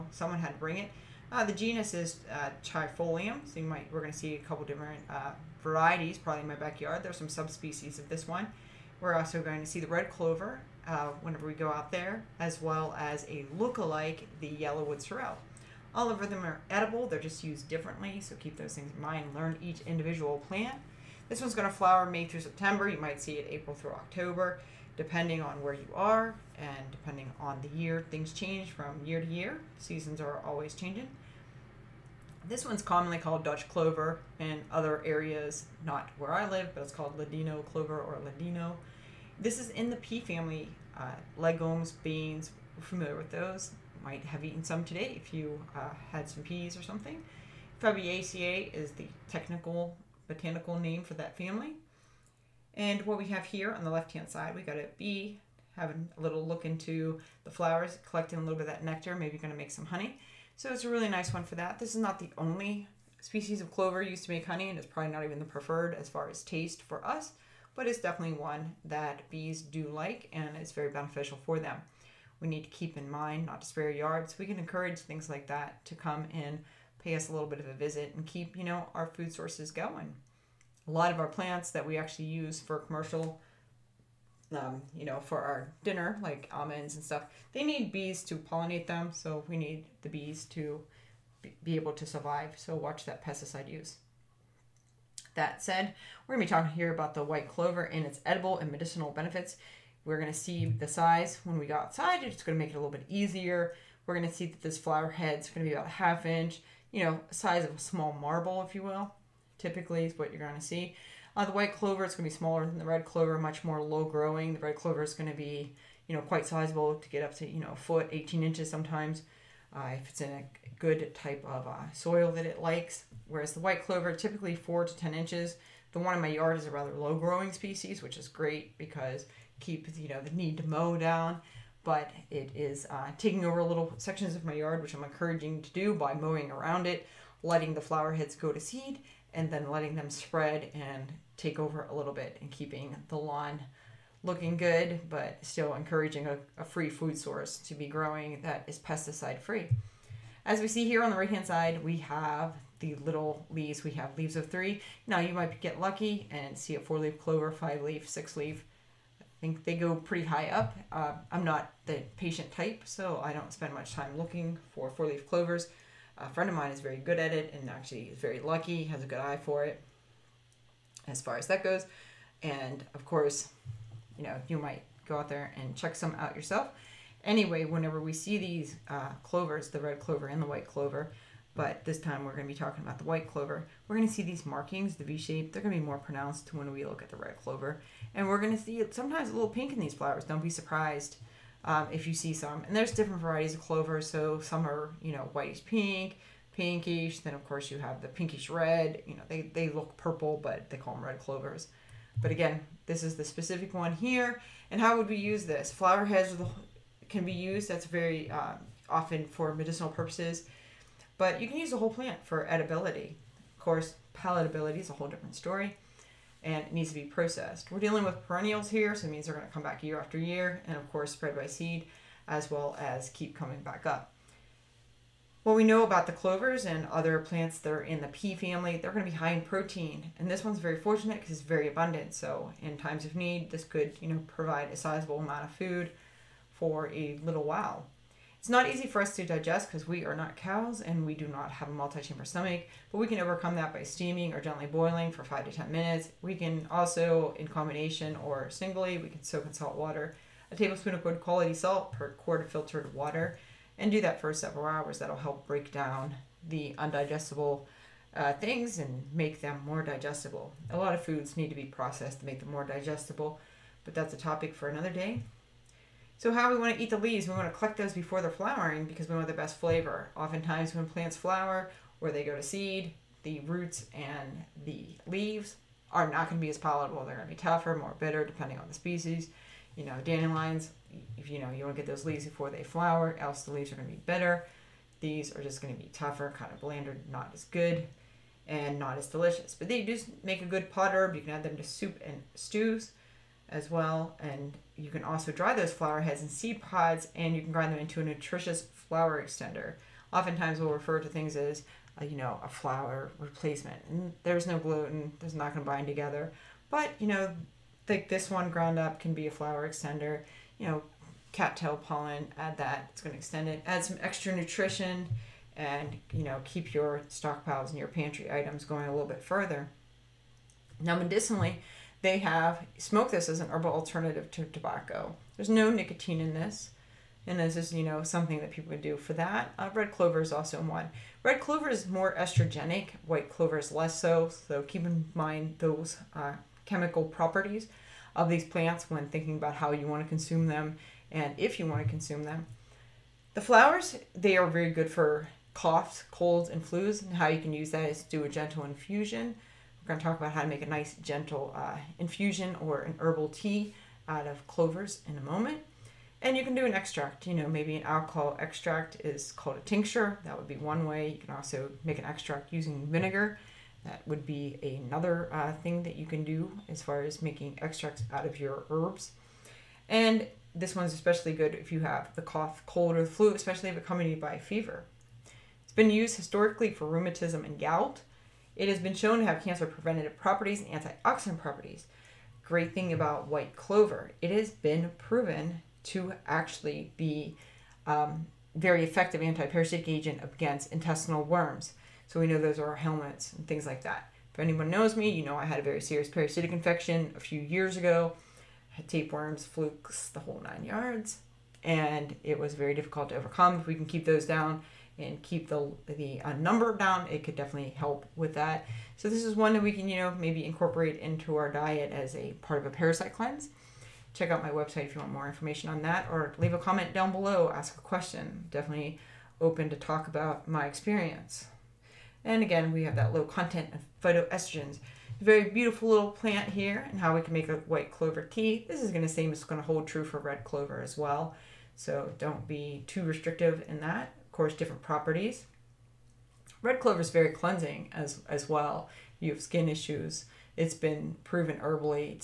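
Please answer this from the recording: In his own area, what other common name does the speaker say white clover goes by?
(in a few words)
Ladino clover.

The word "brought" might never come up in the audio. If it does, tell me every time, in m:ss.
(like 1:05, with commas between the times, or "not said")
not said.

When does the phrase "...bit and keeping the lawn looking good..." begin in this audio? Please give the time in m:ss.
2:22.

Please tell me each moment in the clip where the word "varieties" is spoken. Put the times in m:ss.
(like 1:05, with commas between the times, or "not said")
0:05, 3:13.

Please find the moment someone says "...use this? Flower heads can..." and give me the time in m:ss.
3:25.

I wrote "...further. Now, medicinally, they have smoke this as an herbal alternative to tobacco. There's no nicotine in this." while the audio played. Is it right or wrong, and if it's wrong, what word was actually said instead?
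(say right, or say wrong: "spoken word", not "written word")
right.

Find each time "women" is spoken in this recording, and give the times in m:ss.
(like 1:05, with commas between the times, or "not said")
not said.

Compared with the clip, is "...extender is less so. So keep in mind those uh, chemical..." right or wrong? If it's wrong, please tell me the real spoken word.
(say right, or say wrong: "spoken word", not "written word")
wrong: "clover", not "extender".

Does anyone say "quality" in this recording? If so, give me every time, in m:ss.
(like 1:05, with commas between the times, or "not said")
4:11.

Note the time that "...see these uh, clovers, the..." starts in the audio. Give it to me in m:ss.
2:58.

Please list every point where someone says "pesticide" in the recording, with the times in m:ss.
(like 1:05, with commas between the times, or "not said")
1:33, 2:28.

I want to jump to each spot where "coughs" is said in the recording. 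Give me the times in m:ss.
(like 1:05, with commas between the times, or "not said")
5:45, 6:12.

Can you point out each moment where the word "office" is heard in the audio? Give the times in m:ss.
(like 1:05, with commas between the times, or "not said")
not said.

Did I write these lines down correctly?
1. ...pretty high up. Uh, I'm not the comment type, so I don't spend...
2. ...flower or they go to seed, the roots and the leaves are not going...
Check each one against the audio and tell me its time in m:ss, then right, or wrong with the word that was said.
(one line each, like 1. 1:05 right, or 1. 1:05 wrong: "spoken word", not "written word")
1. 2:39 wrong: "patient", not "comment"
2. 4:31 right.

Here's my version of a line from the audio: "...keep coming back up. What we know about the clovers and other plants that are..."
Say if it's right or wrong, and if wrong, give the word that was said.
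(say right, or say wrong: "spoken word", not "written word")
right.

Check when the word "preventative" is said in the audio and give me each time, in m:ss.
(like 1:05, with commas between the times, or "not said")
6:19.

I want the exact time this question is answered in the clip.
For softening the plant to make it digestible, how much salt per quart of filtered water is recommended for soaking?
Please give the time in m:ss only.
4:10.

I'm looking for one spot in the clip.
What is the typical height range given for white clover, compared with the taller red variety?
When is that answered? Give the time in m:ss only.
2:04.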